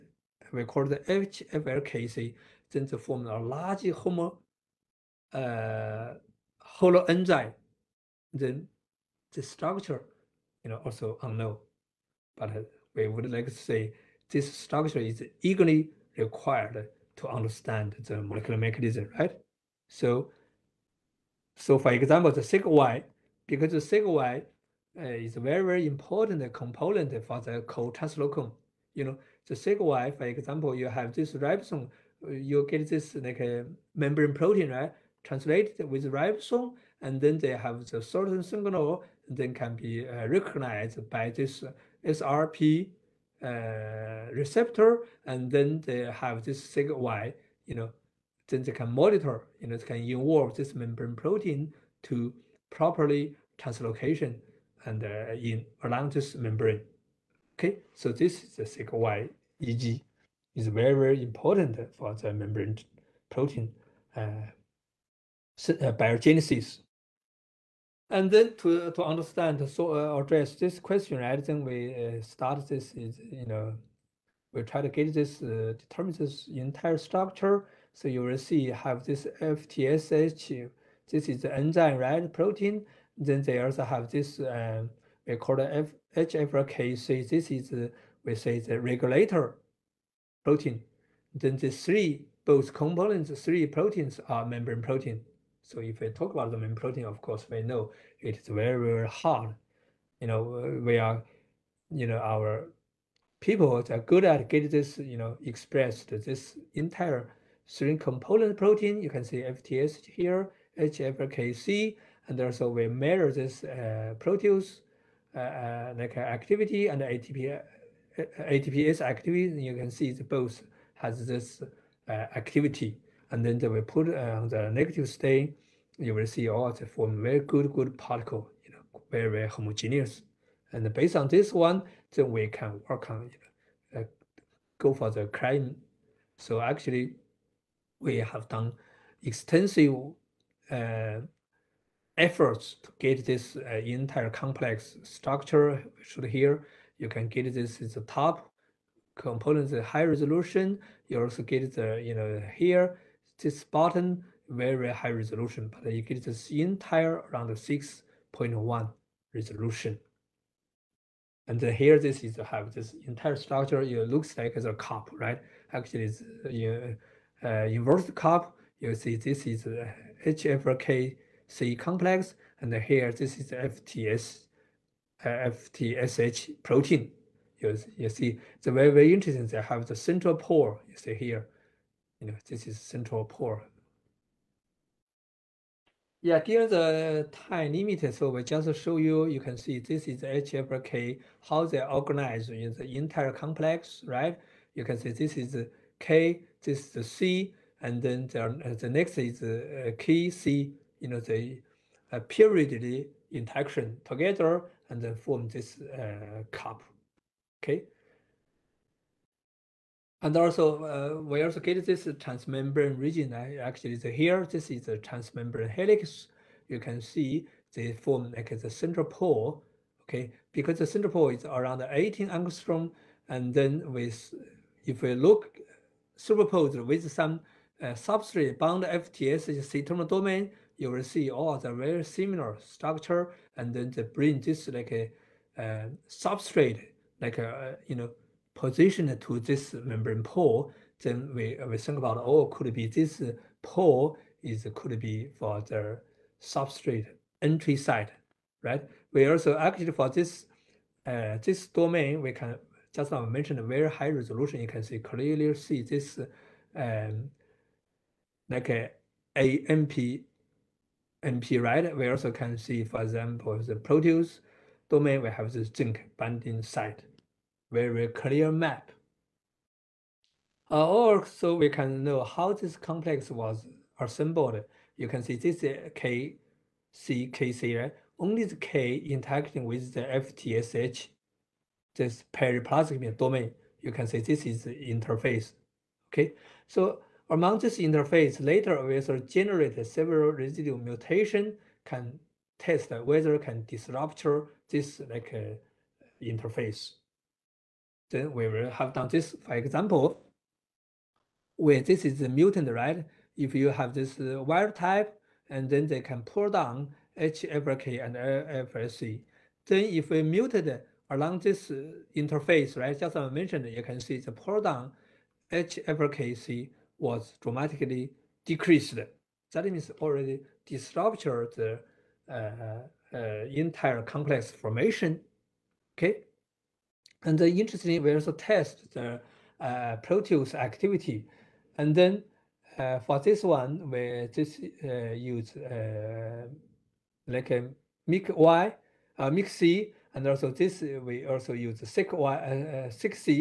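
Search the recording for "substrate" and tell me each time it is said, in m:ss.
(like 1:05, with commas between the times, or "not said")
3:47, 3:56, 4:06.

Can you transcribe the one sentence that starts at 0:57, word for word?
Okay, so this is the SIGY EG is very, very important for the membrane protein uh, uh, biogenesis.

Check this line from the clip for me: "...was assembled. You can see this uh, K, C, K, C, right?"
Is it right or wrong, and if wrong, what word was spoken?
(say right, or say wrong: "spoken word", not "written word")
right.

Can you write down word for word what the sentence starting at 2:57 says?
You, you see, it's very, very interesting.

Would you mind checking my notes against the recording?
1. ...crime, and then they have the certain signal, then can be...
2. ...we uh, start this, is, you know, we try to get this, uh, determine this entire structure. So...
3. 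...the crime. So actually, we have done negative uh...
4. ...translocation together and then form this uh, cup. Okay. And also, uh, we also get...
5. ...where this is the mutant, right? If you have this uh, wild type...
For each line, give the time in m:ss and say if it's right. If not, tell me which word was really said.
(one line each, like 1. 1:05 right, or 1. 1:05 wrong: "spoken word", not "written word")
1. 0:36 wrong: "ribosome", not "crime"
2. 1:11 right
3. 2:15 wrong: "extensive", not "negative"
4. 3:23 wrong: "interaction", not "translocation"
5. 5:01 right.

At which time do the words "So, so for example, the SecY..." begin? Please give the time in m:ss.
0:19.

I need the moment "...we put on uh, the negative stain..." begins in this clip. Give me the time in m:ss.
2:03.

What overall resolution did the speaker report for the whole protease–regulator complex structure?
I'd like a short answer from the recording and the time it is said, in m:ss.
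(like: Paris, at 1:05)
6.1, at 2:37.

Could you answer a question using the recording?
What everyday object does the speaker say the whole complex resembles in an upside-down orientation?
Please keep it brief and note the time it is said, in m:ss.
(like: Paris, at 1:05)
inverse cup, at 2:47.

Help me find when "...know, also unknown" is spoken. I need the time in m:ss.
0:10.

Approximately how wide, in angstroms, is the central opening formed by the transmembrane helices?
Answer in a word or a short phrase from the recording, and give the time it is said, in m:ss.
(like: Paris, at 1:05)
18 angstrom, at 3:41.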